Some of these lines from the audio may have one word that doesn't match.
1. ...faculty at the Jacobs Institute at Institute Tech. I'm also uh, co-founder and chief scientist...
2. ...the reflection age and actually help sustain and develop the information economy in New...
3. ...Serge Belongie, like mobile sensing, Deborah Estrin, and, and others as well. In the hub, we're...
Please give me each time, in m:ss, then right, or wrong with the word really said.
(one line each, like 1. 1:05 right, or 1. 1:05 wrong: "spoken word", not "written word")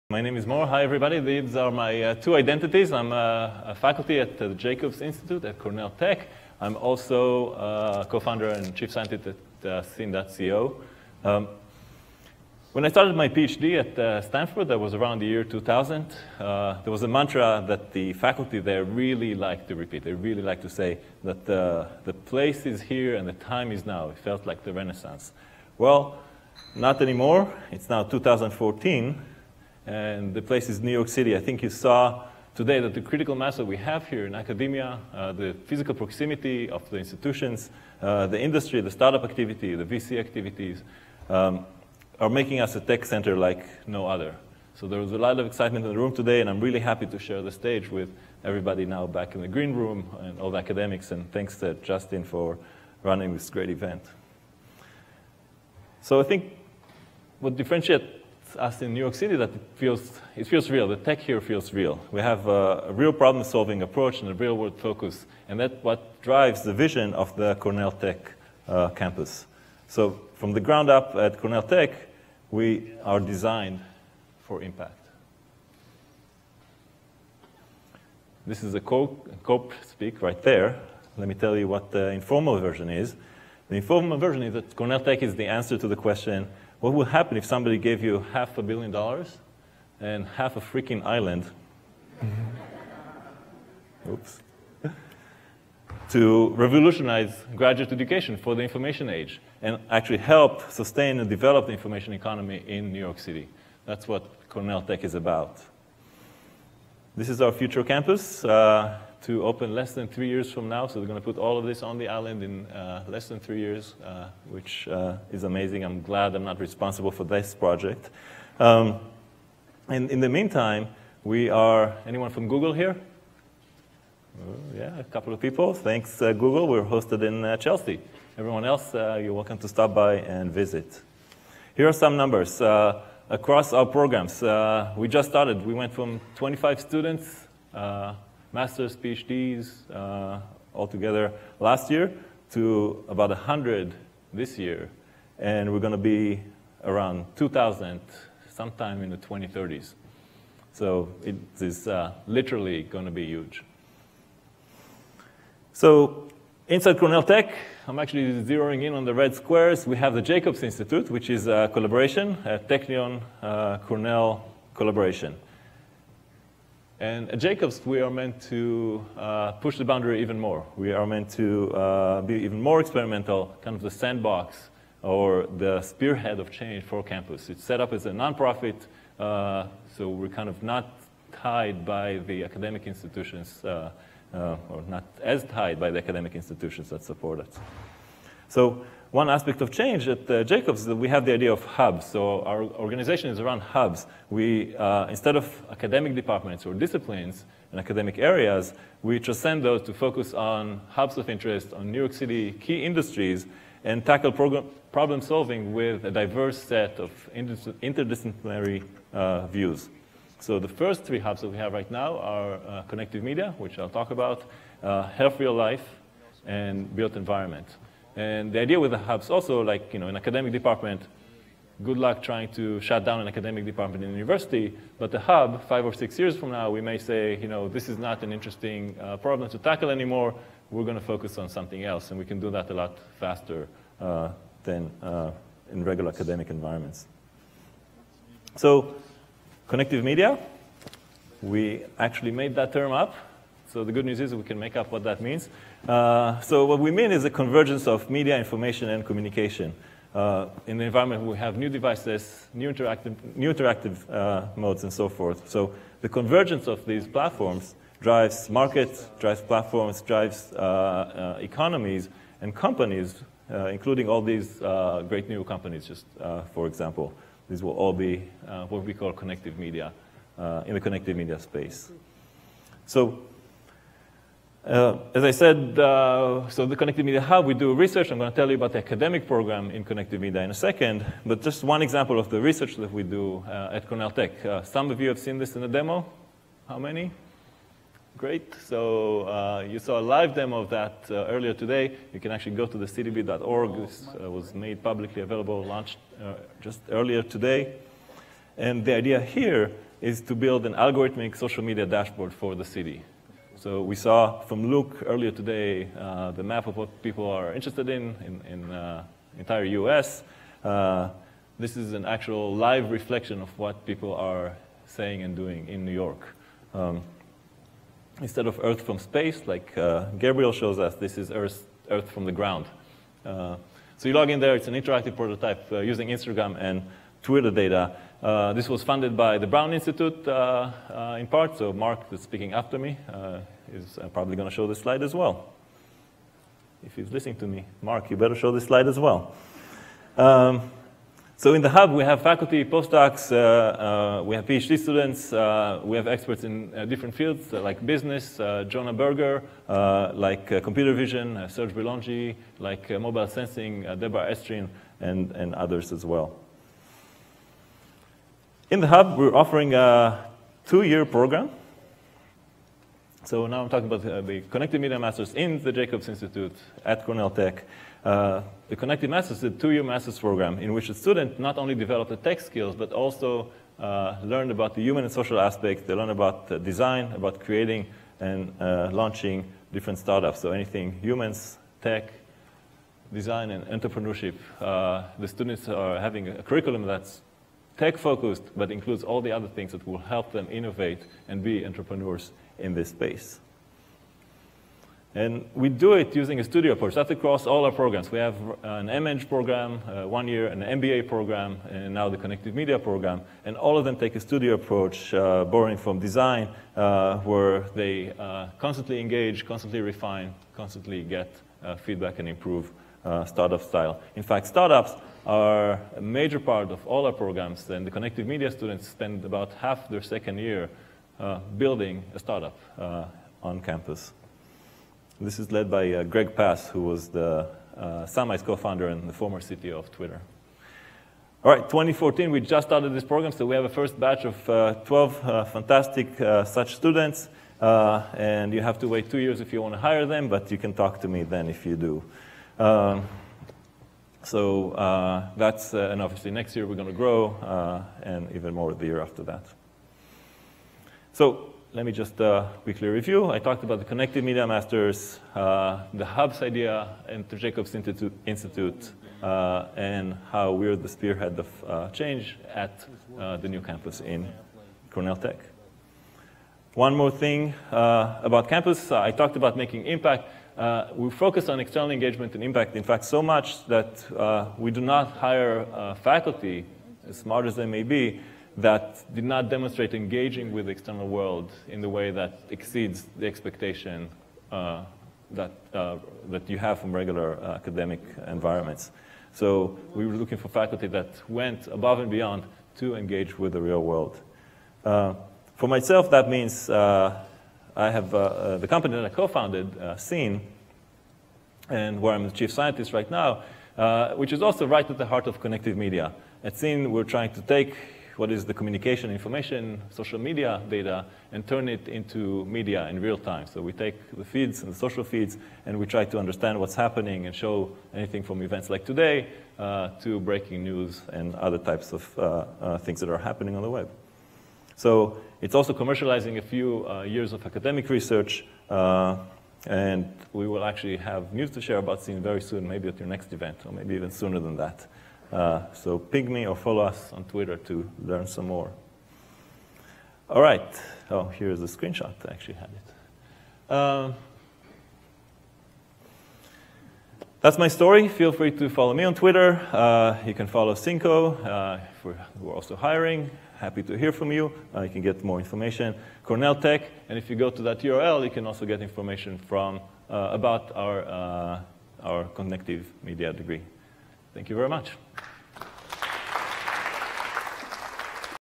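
1. 0:03 wrong: "Cornell", not "Institute"
2. 1:38 wrong: "information", not "reflection"
3. 5:51 right.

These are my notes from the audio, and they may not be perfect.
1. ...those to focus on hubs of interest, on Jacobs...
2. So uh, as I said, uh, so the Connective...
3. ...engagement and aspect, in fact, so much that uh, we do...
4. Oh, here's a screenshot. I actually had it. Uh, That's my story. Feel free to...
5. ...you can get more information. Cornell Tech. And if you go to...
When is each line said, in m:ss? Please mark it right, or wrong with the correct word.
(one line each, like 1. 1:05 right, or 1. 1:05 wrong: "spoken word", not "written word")
1. 3:19 wrong: "New", not "Jacobs"
2. 4:32 right
3. 7:51 wrong: "impact", not "aspect"
4. 9:01 right
5. 9:14 right.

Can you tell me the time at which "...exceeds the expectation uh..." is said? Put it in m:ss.
8:02.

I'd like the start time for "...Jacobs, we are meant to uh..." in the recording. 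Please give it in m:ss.
2:47.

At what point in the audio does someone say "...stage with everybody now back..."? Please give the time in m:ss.
0:47.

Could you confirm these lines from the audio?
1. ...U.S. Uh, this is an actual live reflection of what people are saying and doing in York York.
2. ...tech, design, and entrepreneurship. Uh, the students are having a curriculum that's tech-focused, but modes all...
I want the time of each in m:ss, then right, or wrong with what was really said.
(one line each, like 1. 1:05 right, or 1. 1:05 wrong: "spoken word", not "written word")
1. 5:09 wrong: "New", not "York"
2. 6:21 wrong: "includes", not "modes".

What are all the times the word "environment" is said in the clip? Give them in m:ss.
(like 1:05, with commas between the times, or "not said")
3:37, 3:56, 4:10, 8:08.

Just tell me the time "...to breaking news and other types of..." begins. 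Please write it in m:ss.
8:40.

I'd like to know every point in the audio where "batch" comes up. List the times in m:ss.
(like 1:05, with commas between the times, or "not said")
7:13.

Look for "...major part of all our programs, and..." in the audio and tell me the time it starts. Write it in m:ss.
6:56.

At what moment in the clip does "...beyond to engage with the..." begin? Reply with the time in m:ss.
8:12.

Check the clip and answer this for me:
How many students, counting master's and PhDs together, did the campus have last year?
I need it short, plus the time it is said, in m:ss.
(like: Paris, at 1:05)
25, at 2:16.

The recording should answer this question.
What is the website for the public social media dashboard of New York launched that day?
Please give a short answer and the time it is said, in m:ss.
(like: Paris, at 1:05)
citybeat.org, at 4:52.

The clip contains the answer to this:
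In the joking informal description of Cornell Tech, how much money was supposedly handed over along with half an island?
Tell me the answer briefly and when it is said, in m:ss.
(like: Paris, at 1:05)
half a billion dollars, at 1:28.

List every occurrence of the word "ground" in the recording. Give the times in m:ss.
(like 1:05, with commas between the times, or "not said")
1:10, 5:22.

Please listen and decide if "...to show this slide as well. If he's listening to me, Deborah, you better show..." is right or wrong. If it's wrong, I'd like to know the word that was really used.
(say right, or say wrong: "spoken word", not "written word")
wrong: "Mark", not "Deborah".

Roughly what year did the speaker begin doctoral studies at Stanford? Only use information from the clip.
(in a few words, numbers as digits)
2000.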